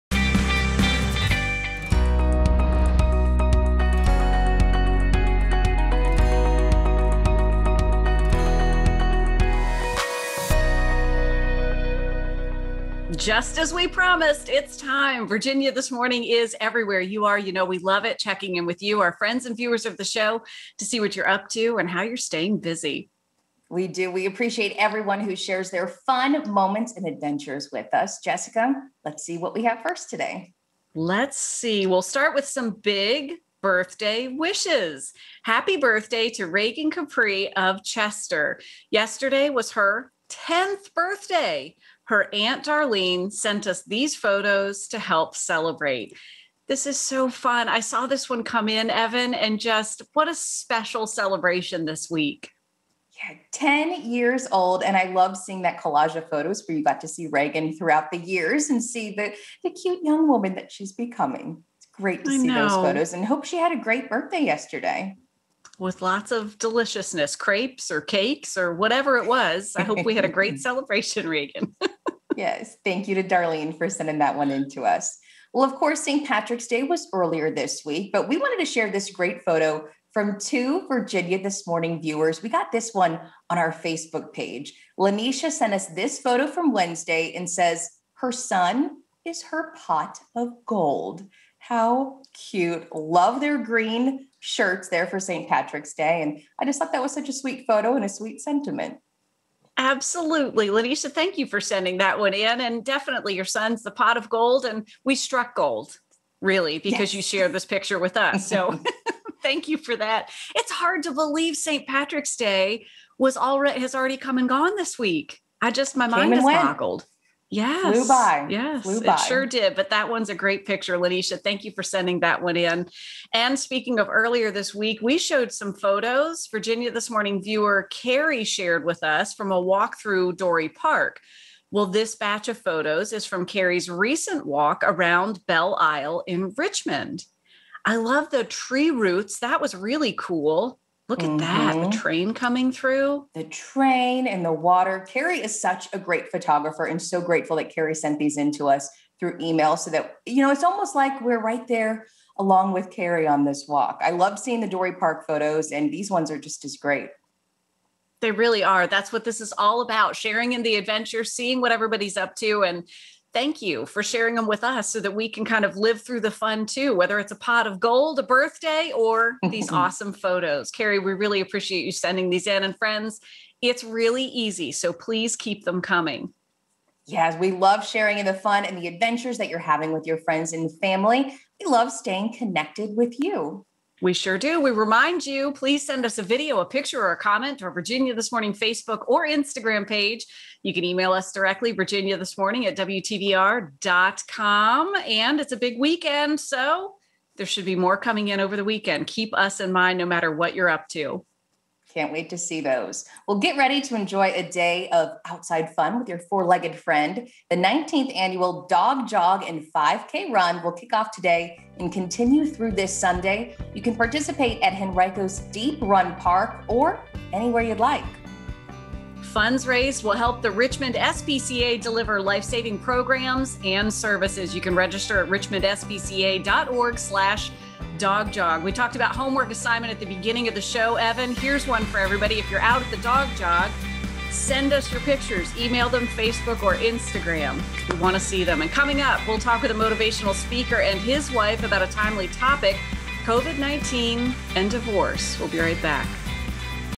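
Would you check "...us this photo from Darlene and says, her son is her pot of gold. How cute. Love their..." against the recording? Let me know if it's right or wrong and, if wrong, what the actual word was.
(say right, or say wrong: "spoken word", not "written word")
wrong: "Wednesday", not "Darlene".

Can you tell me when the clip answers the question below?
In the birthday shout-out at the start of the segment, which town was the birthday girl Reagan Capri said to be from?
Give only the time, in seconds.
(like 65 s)
37 s.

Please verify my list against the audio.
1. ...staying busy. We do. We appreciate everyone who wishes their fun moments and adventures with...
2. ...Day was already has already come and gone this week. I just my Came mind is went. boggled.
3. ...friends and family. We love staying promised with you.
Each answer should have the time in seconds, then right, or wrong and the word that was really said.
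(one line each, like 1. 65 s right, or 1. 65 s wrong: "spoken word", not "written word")
1. 22 s wrong: "shares", not "wishes"
2. 112 s right
3. 180 s wrong: "connected", not "promised".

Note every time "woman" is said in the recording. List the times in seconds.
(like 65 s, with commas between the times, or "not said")
60 s.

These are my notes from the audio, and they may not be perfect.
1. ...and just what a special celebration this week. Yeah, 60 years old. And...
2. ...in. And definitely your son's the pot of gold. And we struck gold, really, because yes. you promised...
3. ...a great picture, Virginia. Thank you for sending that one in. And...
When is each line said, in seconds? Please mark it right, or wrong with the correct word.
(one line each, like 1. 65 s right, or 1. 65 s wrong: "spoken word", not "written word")
1. 49 s wrong: "10", not "60"
2. 102 s wrong: "shared", not "promised"
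3. 120 s wrong: "Lanisha", not "Virginia".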